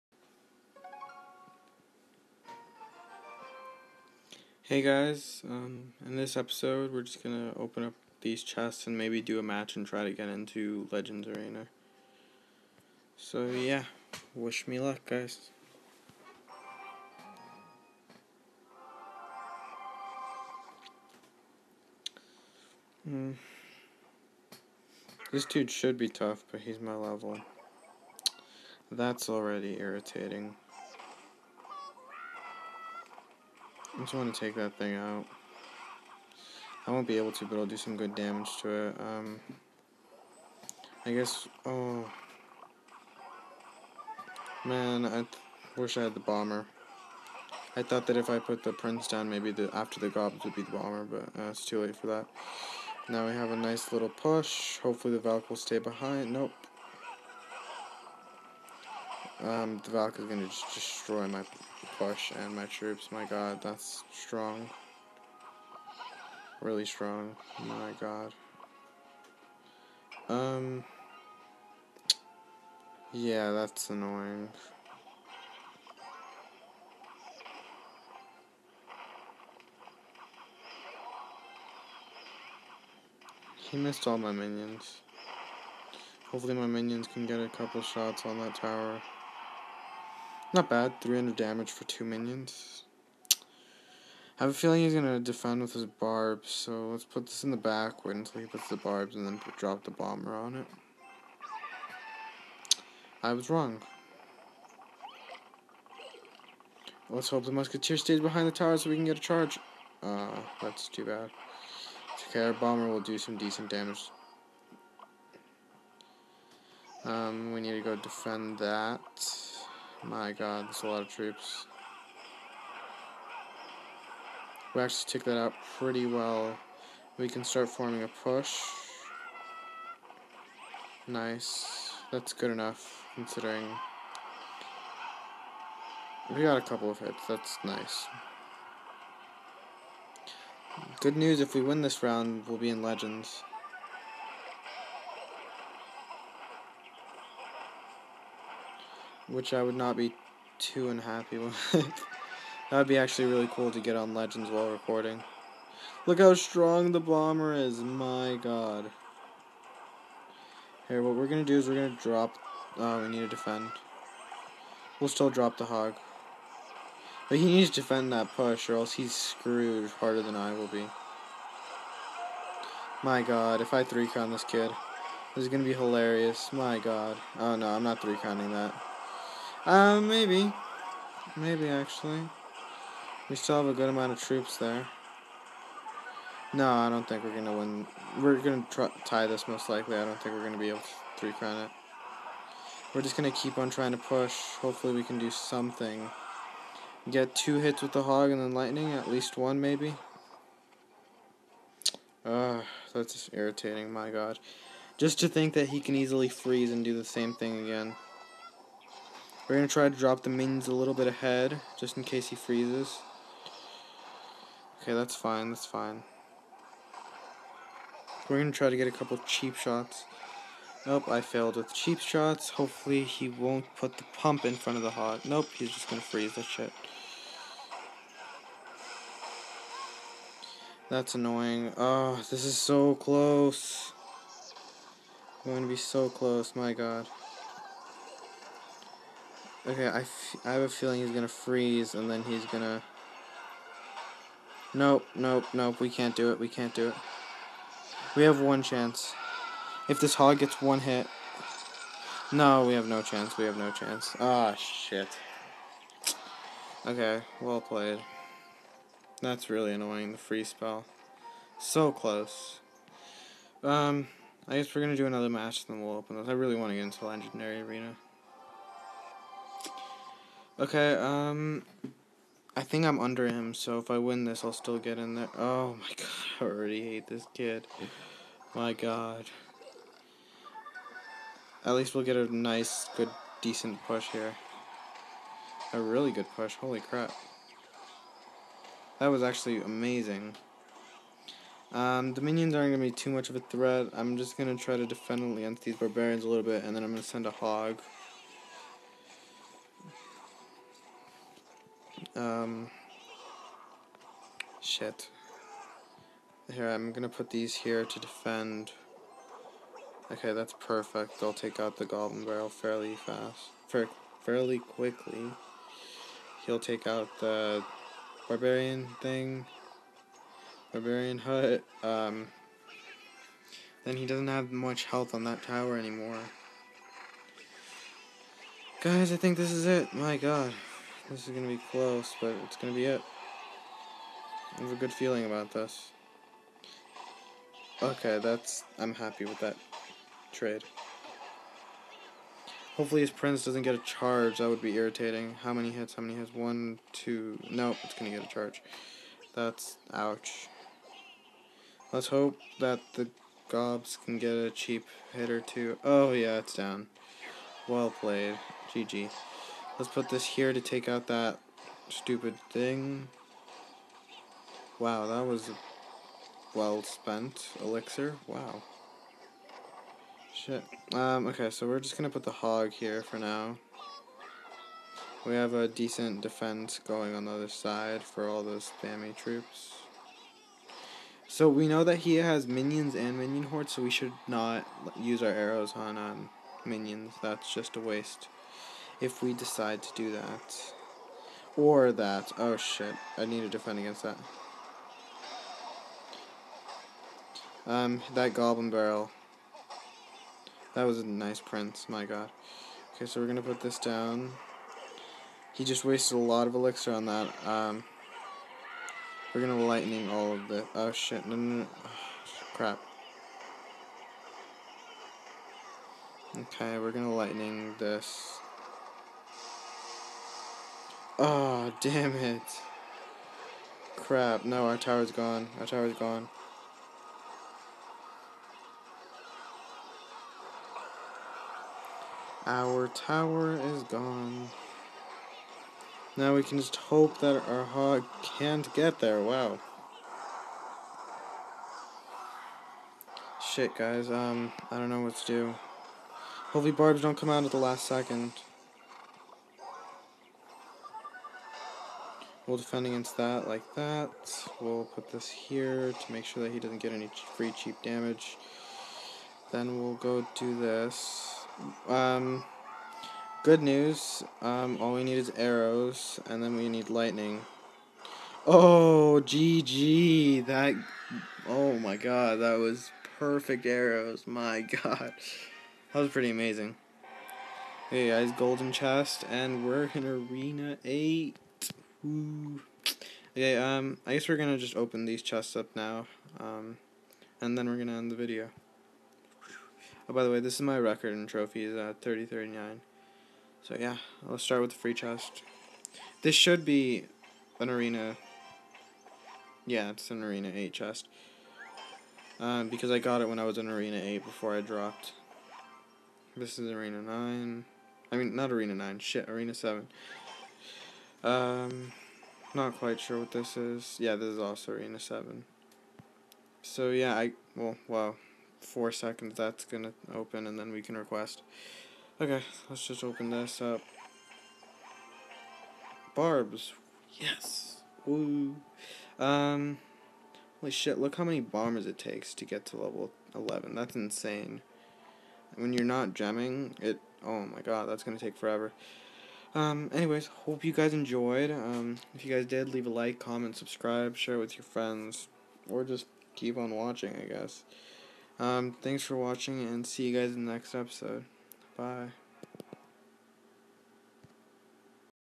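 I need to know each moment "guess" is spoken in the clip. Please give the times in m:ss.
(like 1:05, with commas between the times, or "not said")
0:41, 4:24, 8:04, 9:07.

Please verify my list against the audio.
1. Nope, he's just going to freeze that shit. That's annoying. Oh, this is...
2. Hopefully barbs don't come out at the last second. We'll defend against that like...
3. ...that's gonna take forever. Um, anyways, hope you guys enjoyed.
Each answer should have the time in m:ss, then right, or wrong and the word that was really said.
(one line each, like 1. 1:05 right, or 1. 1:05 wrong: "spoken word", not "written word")
1. 3:45 right
2. 7:26 right
3. 8:57 right.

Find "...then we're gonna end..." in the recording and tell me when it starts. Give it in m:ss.
8:07.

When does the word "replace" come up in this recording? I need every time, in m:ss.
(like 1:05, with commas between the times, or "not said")
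not said.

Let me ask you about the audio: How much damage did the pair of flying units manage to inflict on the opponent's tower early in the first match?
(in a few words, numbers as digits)
300.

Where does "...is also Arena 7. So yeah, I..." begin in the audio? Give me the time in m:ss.
8:34.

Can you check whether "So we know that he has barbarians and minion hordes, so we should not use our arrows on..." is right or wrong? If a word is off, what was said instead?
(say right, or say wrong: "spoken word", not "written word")
wrong: "minions", not "barbarians".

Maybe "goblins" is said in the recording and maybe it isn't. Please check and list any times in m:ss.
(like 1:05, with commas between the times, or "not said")
0:50, 5:11, 6:38.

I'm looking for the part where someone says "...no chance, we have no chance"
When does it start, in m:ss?
4:12.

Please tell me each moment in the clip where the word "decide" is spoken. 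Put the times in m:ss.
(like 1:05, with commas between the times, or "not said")
6:29.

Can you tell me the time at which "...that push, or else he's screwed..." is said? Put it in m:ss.
2:48.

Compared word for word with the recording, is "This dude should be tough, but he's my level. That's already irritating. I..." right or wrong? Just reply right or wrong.
right.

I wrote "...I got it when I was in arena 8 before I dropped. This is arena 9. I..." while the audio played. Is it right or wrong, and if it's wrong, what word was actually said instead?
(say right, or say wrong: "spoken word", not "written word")
right.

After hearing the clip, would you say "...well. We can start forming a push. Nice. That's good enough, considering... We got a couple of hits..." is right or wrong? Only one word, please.
right.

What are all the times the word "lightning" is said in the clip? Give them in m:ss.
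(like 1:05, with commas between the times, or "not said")
3:18, 6:49, 6:57, 7:46.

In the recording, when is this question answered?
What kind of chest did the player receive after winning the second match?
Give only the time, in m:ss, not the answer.
7:58.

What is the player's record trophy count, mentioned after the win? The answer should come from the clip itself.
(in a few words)
3039.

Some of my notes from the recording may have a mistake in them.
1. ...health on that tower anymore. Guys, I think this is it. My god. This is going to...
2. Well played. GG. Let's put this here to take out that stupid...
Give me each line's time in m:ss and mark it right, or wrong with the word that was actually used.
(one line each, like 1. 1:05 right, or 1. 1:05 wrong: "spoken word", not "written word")
1. 5:24 right
2. 5:57 right.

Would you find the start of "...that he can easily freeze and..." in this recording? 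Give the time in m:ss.
3:25.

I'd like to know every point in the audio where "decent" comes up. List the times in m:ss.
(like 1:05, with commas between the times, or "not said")
1:53, 4:43, 6:15.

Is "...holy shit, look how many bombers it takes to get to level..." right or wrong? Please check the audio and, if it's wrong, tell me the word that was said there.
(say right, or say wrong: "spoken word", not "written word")
right.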